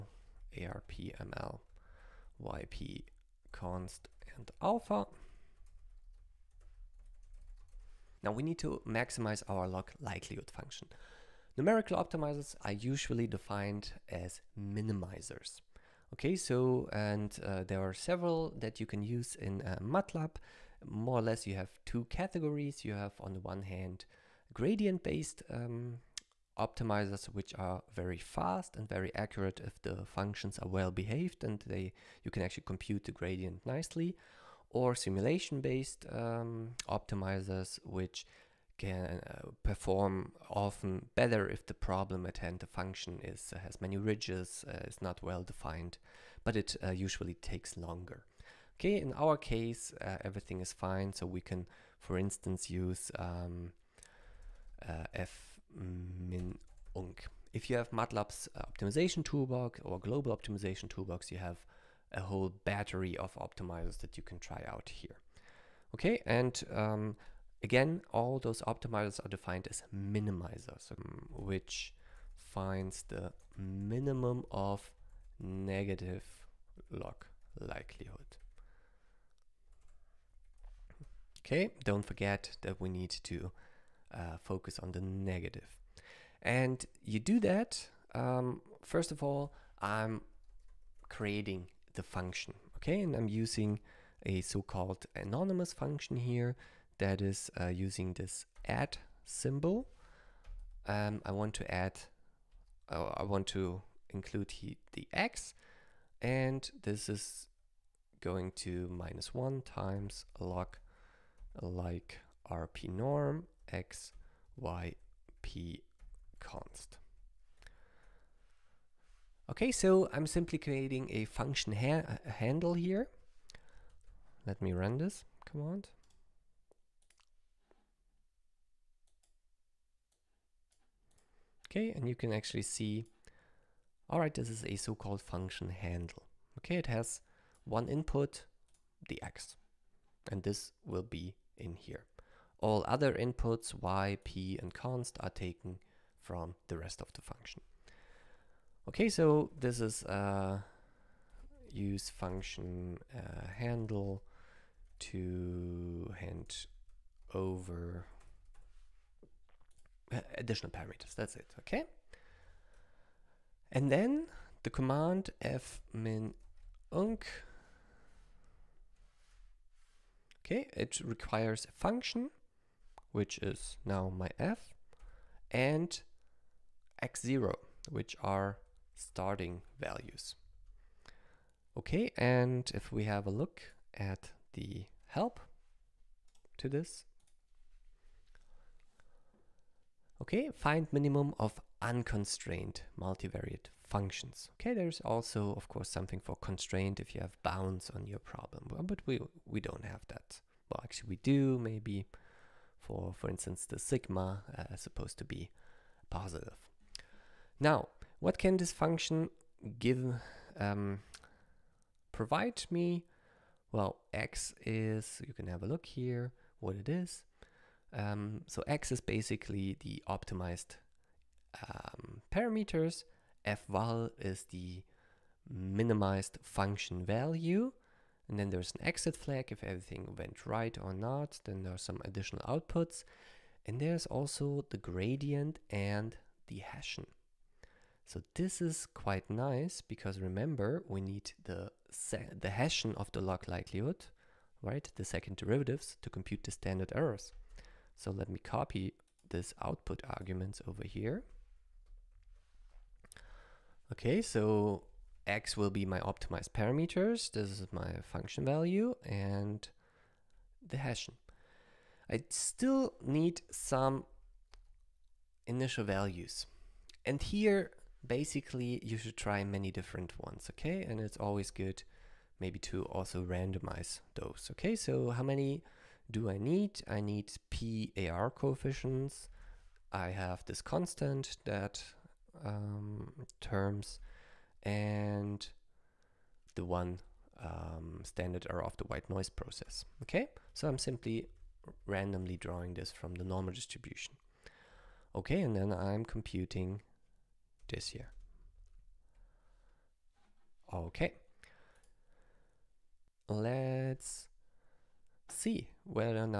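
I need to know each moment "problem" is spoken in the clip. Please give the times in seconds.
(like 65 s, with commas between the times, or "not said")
41 s, 198 s.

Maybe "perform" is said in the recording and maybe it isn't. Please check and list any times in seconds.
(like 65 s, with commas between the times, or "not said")
39 s.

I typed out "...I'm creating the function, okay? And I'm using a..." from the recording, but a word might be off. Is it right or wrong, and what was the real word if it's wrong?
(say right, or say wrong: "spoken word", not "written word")
right.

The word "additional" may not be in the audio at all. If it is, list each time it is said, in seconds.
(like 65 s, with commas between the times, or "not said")
160 s, 232 s.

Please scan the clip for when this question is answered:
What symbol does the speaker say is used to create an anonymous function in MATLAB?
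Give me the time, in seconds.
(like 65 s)
98 s.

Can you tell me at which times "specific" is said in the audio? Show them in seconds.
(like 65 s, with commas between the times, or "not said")
not said.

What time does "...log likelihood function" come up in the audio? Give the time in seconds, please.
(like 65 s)
9 s.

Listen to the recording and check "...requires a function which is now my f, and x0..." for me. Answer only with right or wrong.
right.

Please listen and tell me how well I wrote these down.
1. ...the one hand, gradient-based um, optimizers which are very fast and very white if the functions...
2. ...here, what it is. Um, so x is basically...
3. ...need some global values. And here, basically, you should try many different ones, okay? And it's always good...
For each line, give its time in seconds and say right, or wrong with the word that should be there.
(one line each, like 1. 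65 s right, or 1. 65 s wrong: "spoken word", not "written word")
1. 23 s wrong: "accurate", not "white"
2. 215 s right
3. 263 s wrong: "initial", not "global".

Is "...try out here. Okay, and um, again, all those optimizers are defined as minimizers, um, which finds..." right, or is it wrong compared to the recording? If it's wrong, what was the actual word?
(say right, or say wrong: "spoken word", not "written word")
right.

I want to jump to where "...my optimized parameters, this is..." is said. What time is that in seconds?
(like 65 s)
255 s.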